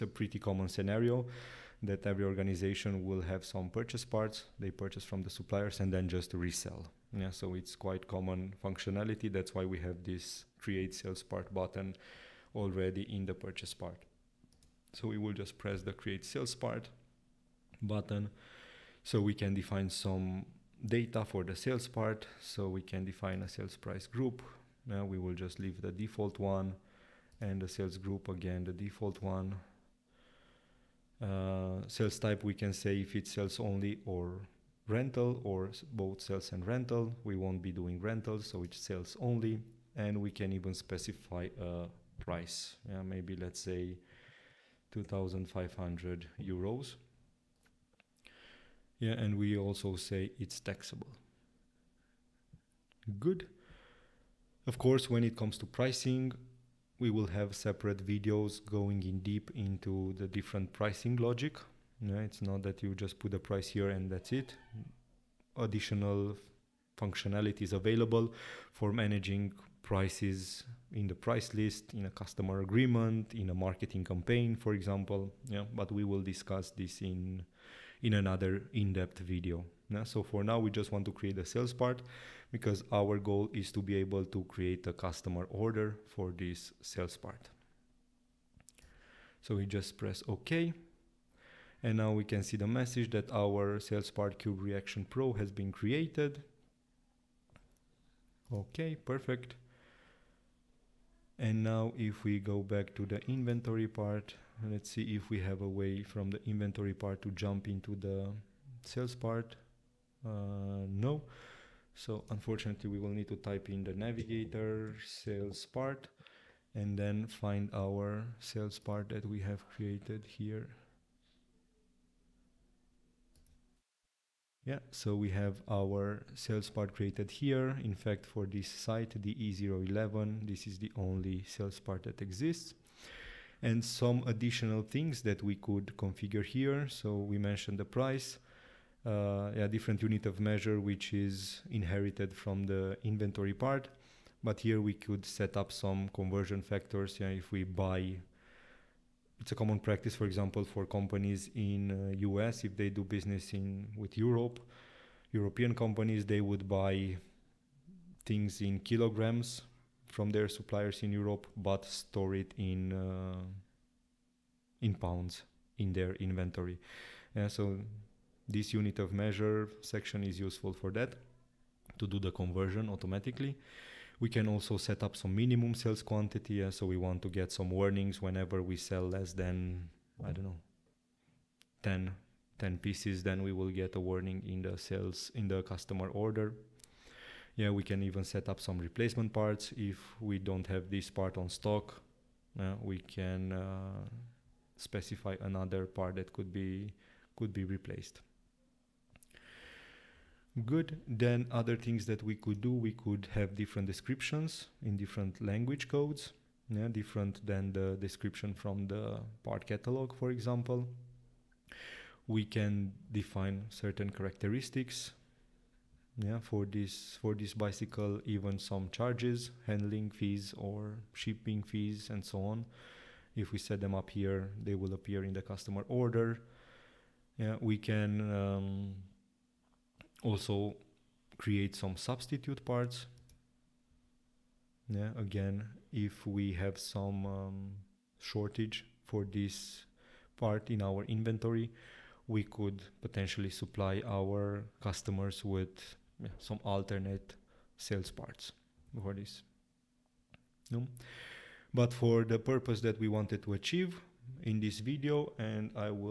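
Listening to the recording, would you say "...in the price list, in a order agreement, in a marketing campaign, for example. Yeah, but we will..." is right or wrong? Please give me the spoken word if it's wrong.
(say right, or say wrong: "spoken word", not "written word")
wrong: "customer", not "order".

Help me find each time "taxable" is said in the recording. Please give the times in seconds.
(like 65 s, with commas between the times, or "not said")
50 s.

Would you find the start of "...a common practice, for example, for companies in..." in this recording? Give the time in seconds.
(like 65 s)
149 s.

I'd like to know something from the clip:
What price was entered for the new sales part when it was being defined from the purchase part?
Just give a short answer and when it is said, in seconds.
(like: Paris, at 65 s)
2500 euros, at 44 s.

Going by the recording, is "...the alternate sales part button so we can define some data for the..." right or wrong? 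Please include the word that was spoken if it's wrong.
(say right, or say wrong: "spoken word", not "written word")
wrong: "create", not "alternate".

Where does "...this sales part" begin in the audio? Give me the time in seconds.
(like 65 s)
86 s.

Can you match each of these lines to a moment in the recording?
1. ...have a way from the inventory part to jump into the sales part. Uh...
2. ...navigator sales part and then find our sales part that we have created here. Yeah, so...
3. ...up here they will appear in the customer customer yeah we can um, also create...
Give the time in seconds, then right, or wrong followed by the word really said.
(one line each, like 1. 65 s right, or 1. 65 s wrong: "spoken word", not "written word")
1. 105 s right
2. 113 s right
3. 223 s wrong: "order", not "customer".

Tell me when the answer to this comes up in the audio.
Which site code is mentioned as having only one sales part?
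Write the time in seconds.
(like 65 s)
129 s.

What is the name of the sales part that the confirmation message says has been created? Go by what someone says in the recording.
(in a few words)
Cube Reaction Pro.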